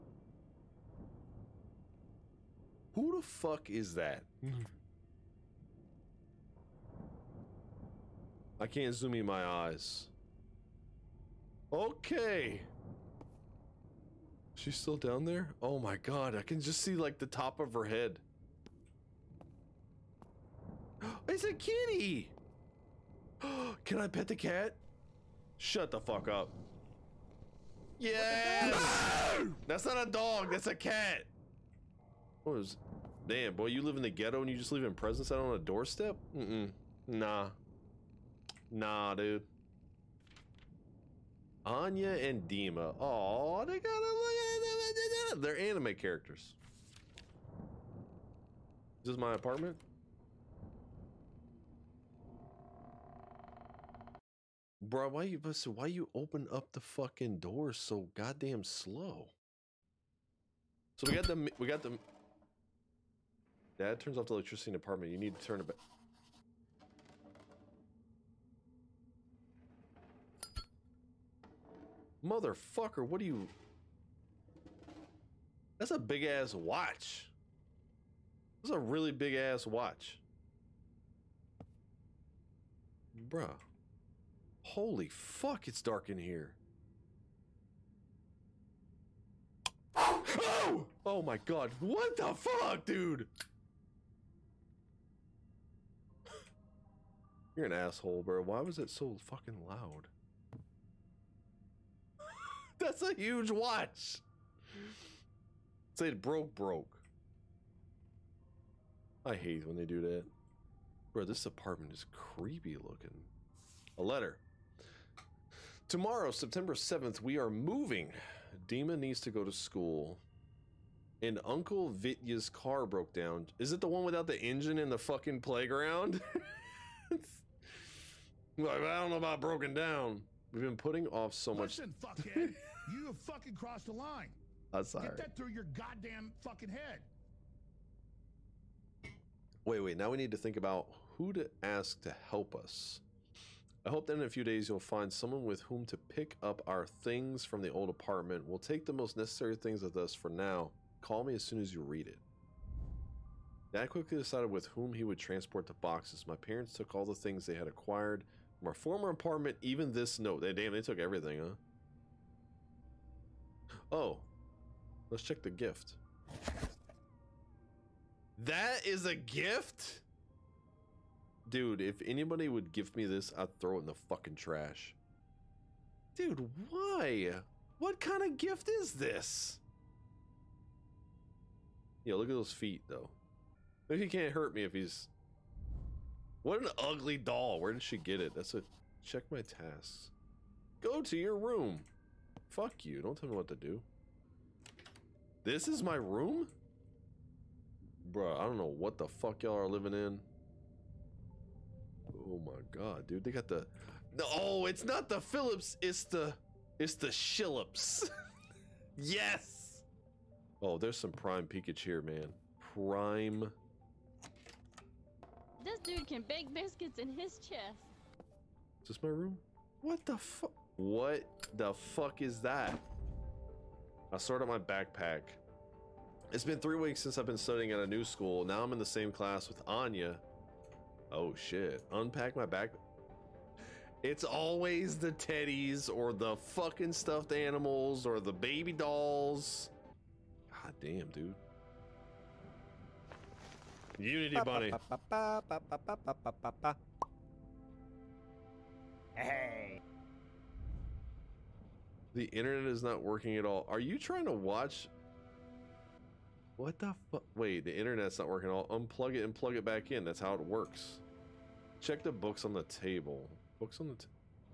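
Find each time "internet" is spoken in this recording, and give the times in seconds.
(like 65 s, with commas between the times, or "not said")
252 s, 257 s.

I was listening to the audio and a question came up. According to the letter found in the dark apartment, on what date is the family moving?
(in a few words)
September 7th.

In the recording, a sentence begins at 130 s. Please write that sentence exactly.
We've been putting off so Listen, much.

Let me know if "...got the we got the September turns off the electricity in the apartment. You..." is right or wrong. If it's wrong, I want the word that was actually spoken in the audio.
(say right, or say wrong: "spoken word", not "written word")
wrong: "Dad", not "September".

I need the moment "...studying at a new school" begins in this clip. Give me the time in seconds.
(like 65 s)
227 s.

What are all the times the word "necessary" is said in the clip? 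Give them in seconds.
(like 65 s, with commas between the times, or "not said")
149 s.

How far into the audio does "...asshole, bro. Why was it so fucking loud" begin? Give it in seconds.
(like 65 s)
97 s.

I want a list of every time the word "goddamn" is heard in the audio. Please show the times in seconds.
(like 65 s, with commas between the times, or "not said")
58 s, 135 s.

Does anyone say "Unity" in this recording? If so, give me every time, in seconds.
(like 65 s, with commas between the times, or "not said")
243 s.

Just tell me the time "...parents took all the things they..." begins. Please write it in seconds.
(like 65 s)
156 s.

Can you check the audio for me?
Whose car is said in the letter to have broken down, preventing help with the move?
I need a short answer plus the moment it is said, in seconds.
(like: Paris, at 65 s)
Uncle Vitya, at 121 s.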